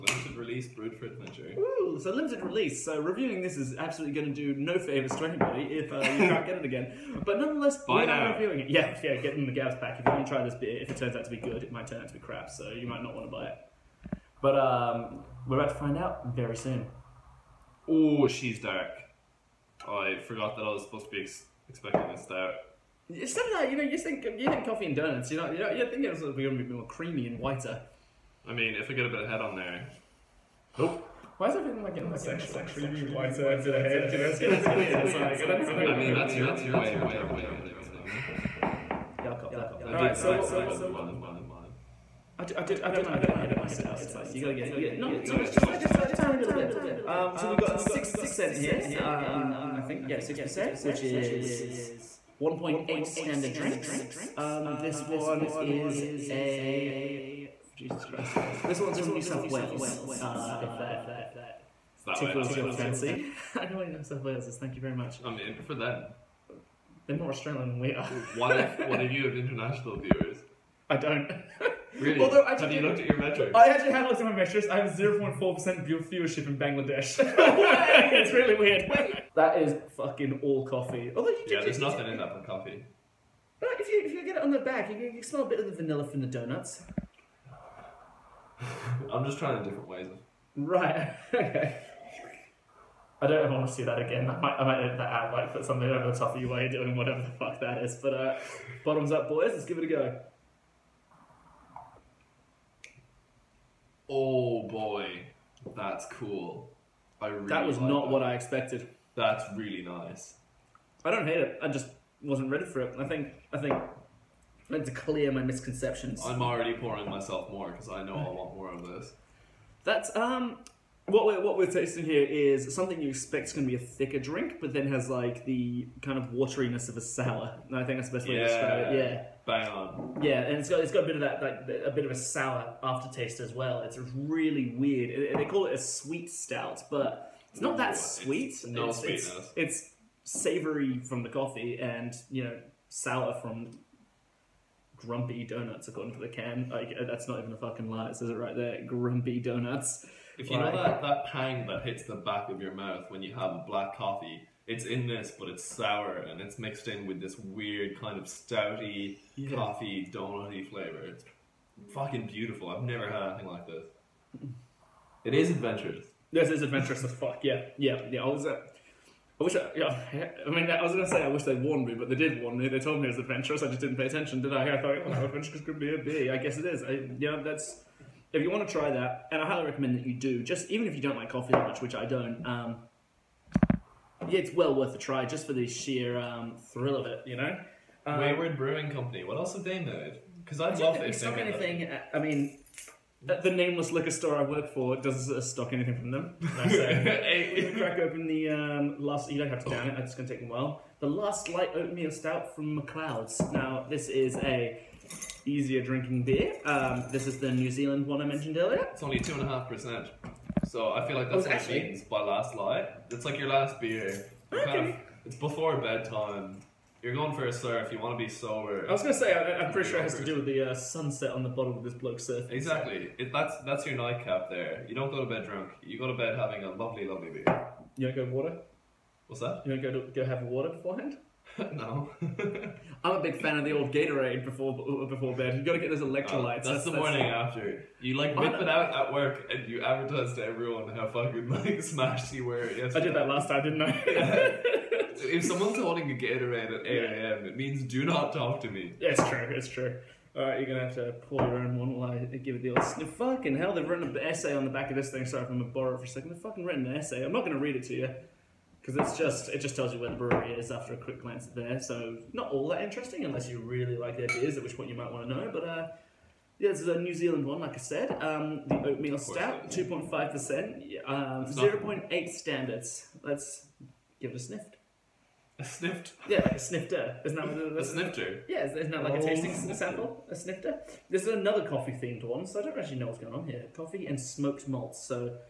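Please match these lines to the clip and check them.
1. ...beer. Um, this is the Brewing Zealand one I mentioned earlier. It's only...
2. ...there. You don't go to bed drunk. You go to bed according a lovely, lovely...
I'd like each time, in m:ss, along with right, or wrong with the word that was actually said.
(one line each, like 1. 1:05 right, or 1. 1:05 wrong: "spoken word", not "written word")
1. 3:26 wrong: "New", not "Brewing"
2. 3:44 wrong: "having", not "according".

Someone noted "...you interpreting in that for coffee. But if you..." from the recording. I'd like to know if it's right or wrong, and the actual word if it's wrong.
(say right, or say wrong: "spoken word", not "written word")
wrong: "nothing", not "interpreting".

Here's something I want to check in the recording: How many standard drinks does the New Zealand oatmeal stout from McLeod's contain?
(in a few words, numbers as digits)
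0.8.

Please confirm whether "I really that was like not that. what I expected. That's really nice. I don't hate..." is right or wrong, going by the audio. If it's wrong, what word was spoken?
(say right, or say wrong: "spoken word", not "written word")
right.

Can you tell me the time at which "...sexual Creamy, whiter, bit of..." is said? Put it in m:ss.
0:32.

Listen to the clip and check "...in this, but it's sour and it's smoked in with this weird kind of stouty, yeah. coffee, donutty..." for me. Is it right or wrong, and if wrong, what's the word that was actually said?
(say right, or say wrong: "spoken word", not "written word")
wrong: "mixed", not "smoked".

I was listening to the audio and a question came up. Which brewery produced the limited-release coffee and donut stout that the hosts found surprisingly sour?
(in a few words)
Wayward Brewing Company.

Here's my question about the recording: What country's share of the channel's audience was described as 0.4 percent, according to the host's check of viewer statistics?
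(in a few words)
Bangladesh.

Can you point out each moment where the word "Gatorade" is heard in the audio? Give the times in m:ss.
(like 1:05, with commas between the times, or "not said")
3:53, 4:06.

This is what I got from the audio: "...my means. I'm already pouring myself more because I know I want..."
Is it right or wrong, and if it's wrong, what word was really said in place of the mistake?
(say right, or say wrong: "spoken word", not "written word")
wrong: "misconceptions", not "means".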